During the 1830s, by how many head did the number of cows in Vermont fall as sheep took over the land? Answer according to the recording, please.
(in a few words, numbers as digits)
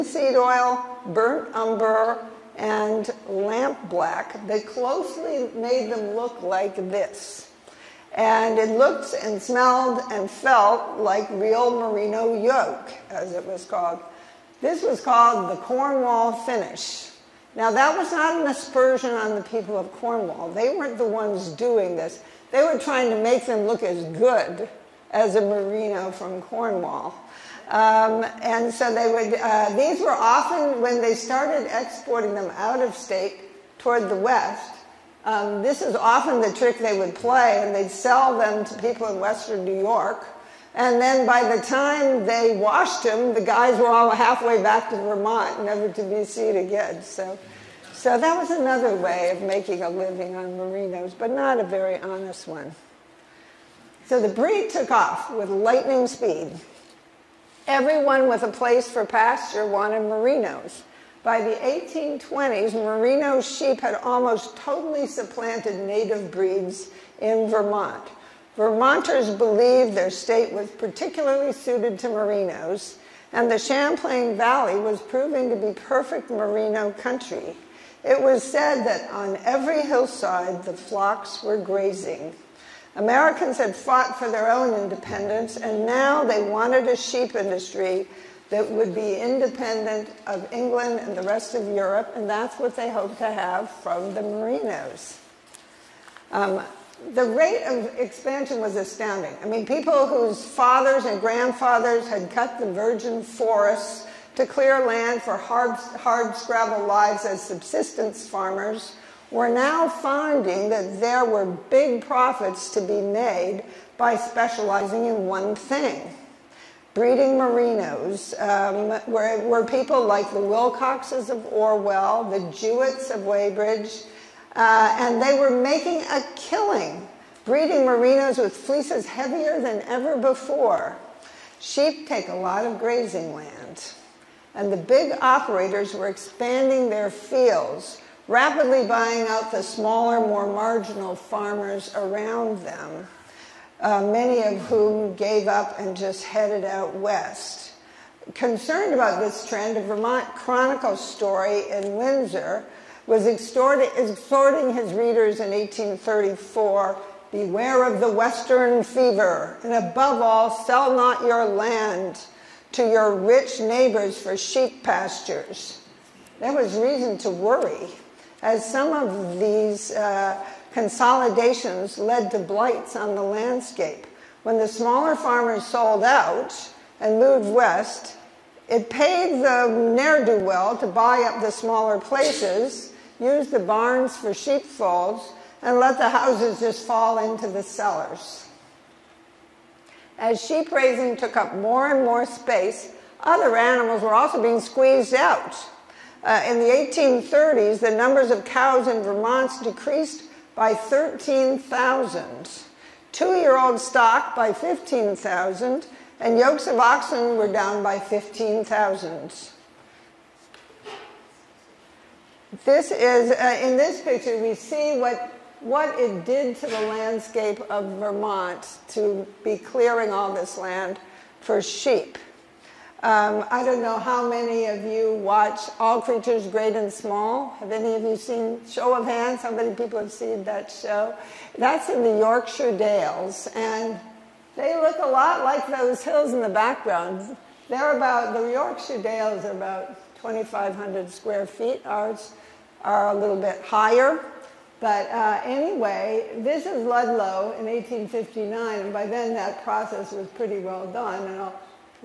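13,000.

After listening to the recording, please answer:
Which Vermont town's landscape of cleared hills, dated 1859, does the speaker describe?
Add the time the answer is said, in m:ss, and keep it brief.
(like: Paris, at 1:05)
Ludlow, at 4:06.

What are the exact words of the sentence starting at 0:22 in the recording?
They were trying to make them look as good as a merino from Cornwall.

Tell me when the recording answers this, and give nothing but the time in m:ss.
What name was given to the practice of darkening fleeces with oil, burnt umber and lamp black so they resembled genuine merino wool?
0:15.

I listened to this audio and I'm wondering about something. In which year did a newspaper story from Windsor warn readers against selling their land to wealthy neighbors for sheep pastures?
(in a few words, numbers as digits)
1834.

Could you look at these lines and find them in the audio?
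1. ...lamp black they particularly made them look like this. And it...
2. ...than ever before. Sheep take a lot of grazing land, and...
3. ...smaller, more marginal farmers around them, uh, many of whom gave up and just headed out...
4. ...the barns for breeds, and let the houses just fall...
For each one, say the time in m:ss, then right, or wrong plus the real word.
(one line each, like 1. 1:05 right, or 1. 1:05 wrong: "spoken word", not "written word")
1. 0:03 wrong: "closely", not "particularly"
2. 2:09 right
3. 2:19 right
4. 3:03 wrong: "sheepfolds", not "breeds".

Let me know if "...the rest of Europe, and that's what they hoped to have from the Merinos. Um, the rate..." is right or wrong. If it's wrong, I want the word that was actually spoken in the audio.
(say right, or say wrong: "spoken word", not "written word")
right.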